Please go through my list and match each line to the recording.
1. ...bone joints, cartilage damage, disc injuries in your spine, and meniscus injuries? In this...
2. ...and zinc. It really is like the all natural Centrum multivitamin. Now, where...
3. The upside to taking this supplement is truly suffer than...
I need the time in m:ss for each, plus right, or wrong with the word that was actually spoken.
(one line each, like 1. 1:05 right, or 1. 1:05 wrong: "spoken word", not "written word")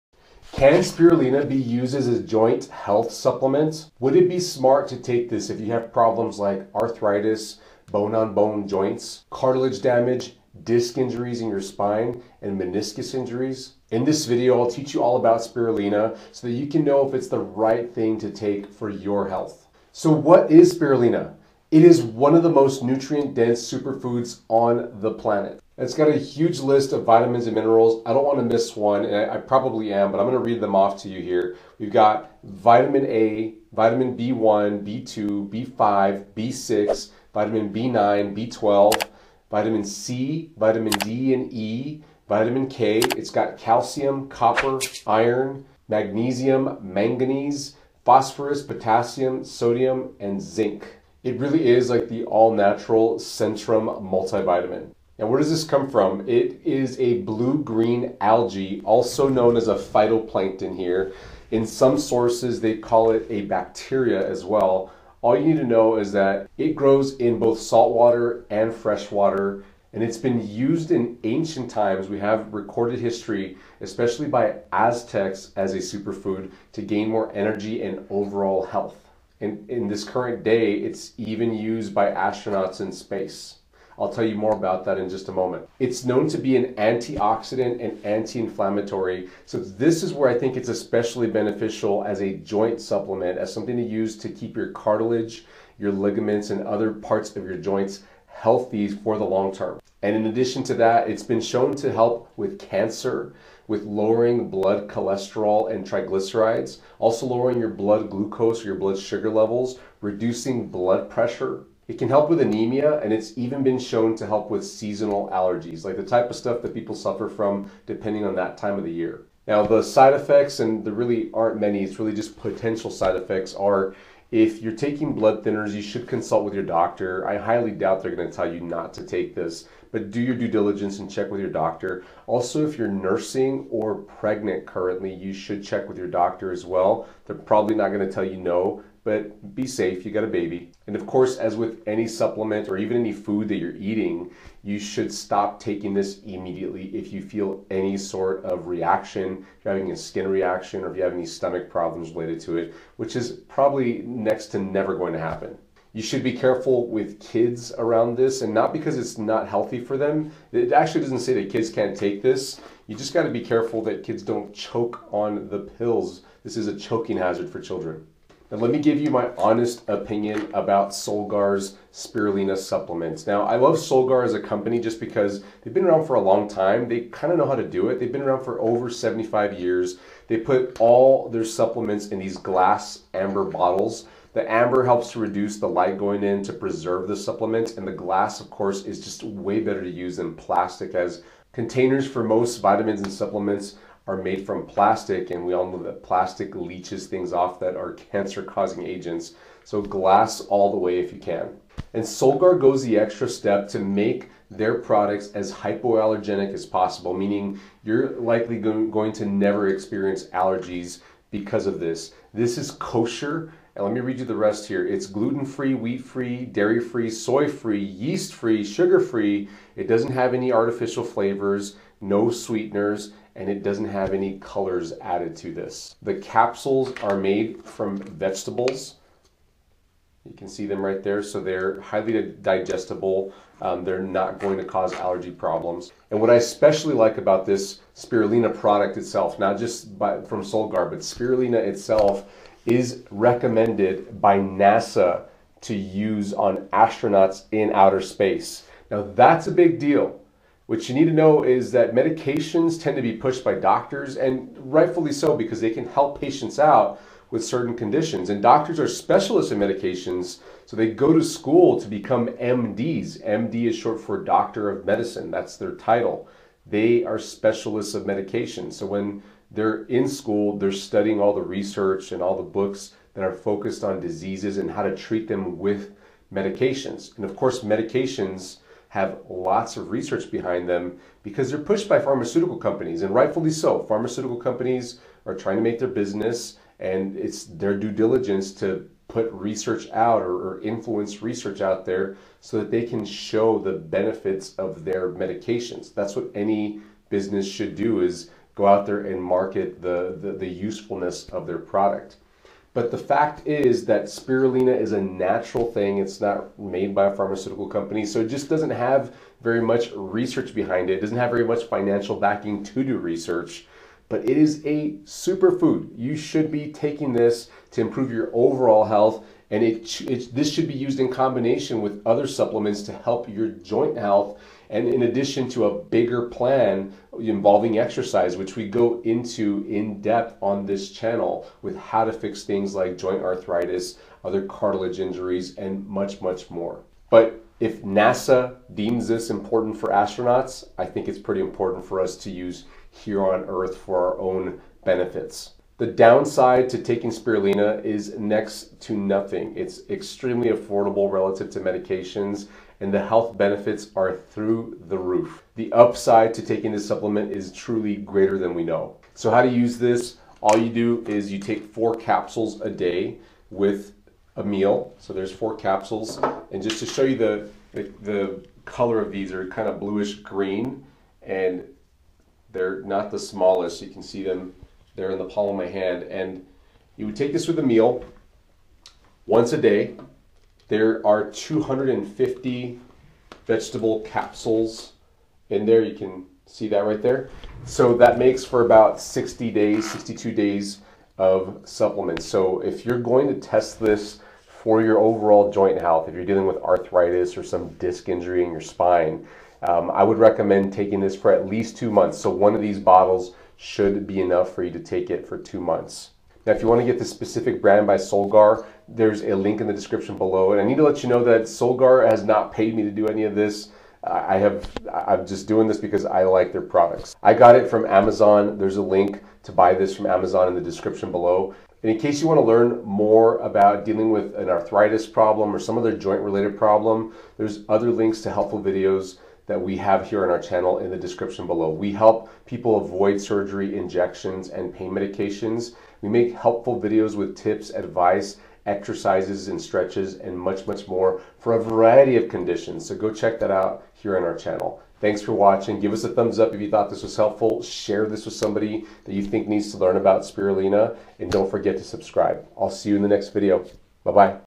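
1. 0:08 right
2. 0:50 right
3. 5:55 wrong: "greater", not "suffer".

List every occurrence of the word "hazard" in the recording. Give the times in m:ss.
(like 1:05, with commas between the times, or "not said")
2:47.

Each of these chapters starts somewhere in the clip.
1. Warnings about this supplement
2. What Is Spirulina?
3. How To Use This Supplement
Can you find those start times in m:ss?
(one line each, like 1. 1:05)
1. 2:00
2. 0:19
3. 5:58.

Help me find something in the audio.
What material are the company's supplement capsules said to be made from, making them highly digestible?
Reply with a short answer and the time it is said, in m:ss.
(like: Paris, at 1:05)
vegetables, at 3:47.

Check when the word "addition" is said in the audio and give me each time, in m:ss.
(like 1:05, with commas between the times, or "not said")
1:40, 5:25.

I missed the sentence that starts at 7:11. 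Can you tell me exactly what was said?
We help people avoid surgery, injections, and pain medications.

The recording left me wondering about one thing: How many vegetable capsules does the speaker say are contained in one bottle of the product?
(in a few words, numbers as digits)
250.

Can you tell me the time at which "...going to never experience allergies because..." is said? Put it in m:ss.
3:28.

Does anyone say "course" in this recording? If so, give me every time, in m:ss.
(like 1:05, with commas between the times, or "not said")
2:21, 3:08, 4:37.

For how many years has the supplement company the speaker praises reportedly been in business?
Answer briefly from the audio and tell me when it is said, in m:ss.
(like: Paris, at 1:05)
over 75 years, at 2:58.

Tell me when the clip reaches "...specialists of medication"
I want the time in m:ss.
4:27.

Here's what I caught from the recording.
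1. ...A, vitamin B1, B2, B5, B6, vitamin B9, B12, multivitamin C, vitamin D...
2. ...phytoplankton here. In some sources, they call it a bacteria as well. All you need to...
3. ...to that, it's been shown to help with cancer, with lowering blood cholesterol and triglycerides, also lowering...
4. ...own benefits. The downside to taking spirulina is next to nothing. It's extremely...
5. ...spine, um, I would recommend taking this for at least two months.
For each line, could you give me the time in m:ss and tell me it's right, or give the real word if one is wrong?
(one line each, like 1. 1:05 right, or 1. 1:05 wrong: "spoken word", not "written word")
1. 0:33 wrong: "vitamin", not "multivitamin"
2. 0:59 right
3. 1:40 right
4. 5:44 right
5. 6:38 right.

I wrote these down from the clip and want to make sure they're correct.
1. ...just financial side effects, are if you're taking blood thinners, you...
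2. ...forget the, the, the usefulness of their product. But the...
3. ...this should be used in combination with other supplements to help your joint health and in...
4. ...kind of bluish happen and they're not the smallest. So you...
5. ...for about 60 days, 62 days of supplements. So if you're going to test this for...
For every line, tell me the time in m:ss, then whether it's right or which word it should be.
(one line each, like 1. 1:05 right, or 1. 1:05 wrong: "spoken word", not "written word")
1. 2:02 wrong: "potential", not "financial"
2. 4:59 wrong: "market", not "forget"
3. 5:20 right
4. 6:09 wrong: "green", not "happen"
5. 6:28 right.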